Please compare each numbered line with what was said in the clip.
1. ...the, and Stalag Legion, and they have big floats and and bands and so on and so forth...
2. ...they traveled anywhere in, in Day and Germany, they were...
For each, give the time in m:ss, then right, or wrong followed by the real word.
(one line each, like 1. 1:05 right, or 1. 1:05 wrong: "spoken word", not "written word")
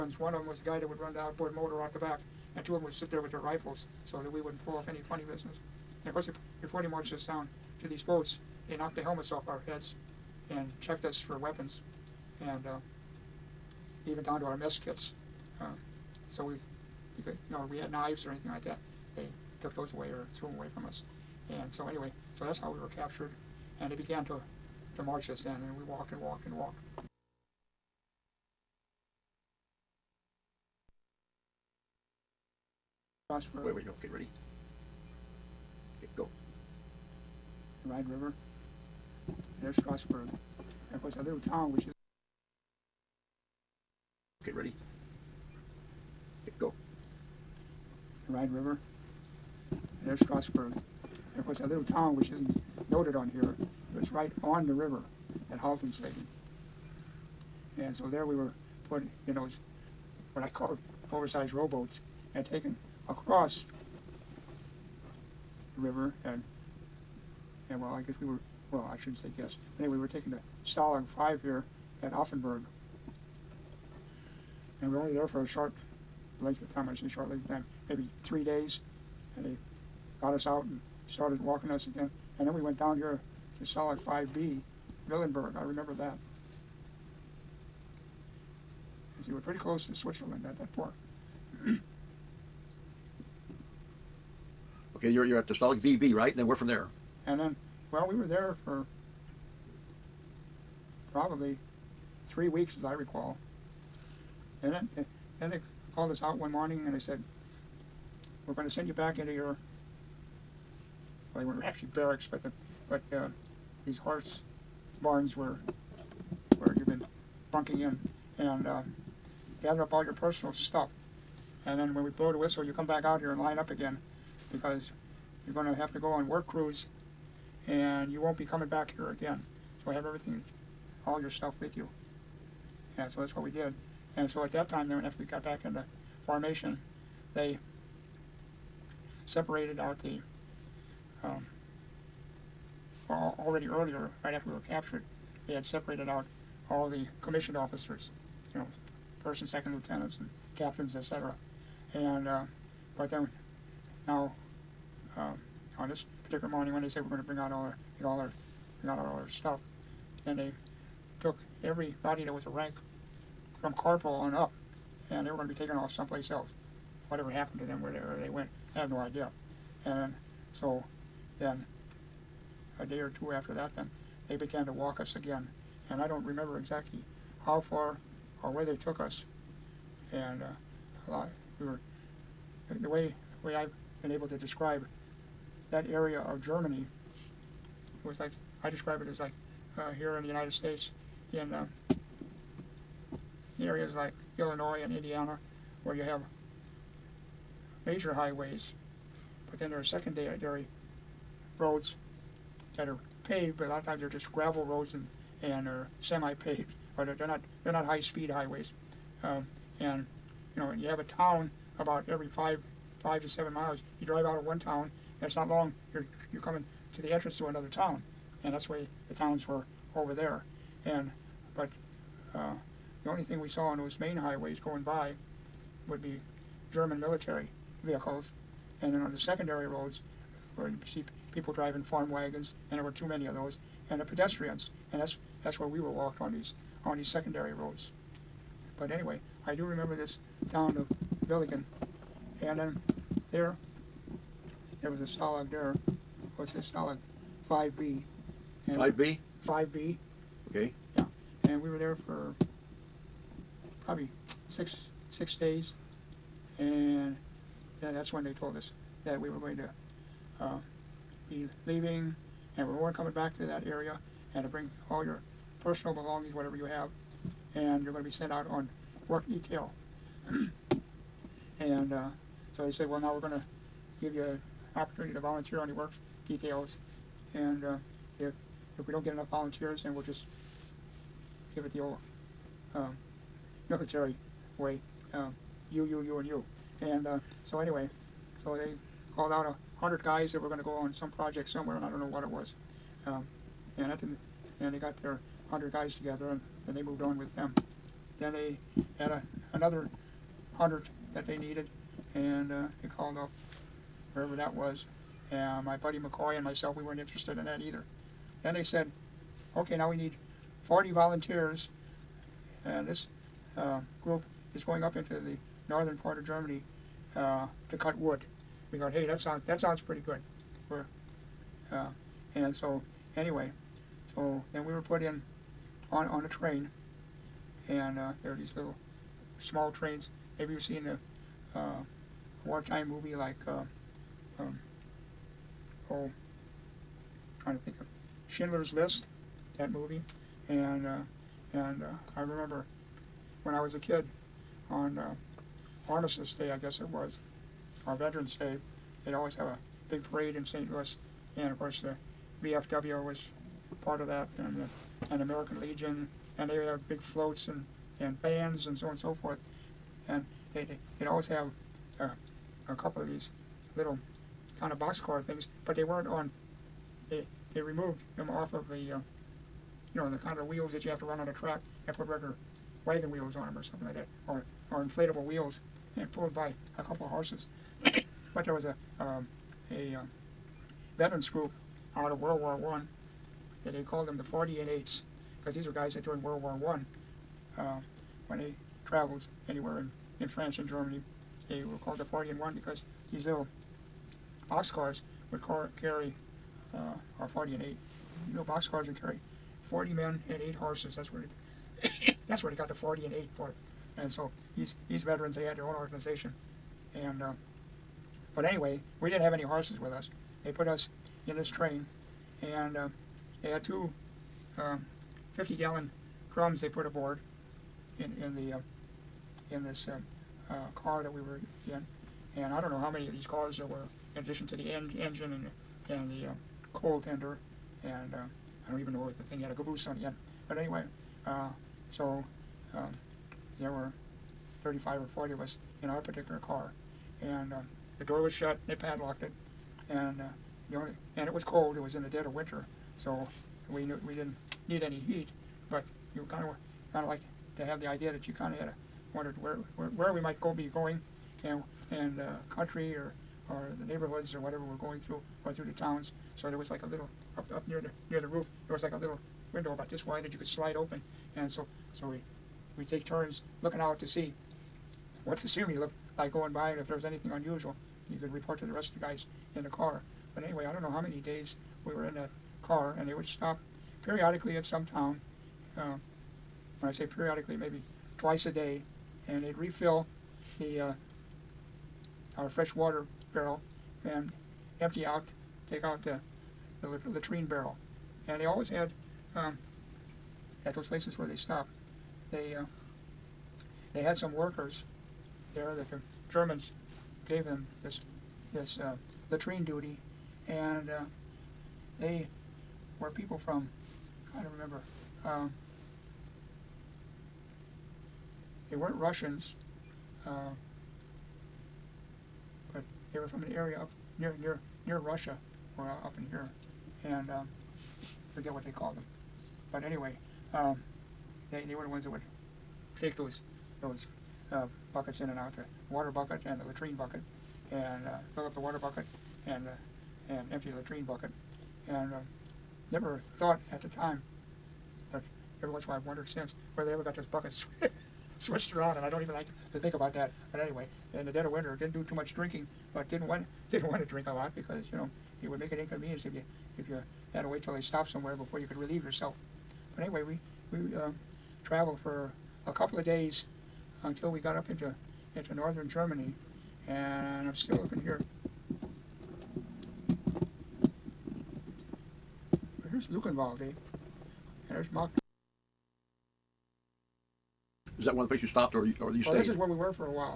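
1. 5:54 wrong: "American", not "Stalag"
2. 6:28 wrong: "France", not "Day".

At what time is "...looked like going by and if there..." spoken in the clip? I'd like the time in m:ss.
7:45.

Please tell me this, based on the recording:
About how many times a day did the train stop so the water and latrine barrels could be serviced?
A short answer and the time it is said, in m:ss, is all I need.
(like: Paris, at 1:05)
twice a day, at 7:58.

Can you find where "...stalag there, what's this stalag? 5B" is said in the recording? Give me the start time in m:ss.
4:05.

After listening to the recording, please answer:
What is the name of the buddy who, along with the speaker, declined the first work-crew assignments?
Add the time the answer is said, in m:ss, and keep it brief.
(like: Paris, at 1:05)
McCoy, at 5:05.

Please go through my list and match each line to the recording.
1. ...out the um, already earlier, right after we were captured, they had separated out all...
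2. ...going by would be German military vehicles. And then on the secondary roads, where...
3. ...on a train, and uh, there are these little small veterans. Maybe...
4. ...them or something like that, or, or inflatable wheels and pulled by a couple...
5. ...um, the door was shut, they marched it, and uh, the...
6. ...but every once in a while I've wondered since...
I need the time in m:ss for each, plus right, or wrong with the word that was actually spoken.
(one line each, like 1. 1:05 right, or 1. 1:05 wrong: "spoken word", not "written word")
1. 2:19 right
2. 3:44 right
3. 5:26 wrong: "trains", not "veterans"
4. 6:13 right
5. 7:17 wrong: "padlocked", not "marched"
6. 8:55 right.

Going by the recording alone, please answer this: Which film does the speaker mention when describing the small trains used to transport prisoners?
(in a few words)
Schindler's List.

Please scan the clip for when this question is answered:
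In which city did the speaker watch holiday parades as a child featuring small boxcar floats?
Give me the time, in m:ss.
5:50.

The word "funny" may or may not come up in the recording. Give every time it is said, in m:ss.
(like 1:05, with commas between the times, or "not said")
0:05.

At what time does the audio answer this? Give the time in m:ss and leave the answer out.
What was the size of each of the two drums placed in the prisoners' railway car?
6:54.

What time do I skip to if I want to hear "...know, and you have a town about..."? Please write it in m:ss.
3:30.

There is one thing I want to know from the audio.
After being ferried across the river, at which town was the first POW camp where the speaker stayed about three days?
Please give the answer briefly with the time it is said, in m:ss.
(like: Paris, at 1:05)
Offenburg, at 1:12.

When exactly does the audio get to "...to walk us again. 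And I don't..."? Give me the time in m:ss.
2:54.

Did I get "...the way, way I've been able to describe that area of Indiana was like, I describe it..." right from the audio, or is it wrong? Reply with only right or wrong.
wrong.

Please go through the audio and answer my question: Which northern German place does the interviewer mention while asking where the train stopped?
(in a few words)
Luckenwalde.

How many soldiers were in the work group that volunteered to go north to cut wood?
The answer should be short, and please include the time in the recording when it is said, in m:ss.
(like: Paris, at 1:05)
40, at 5:10.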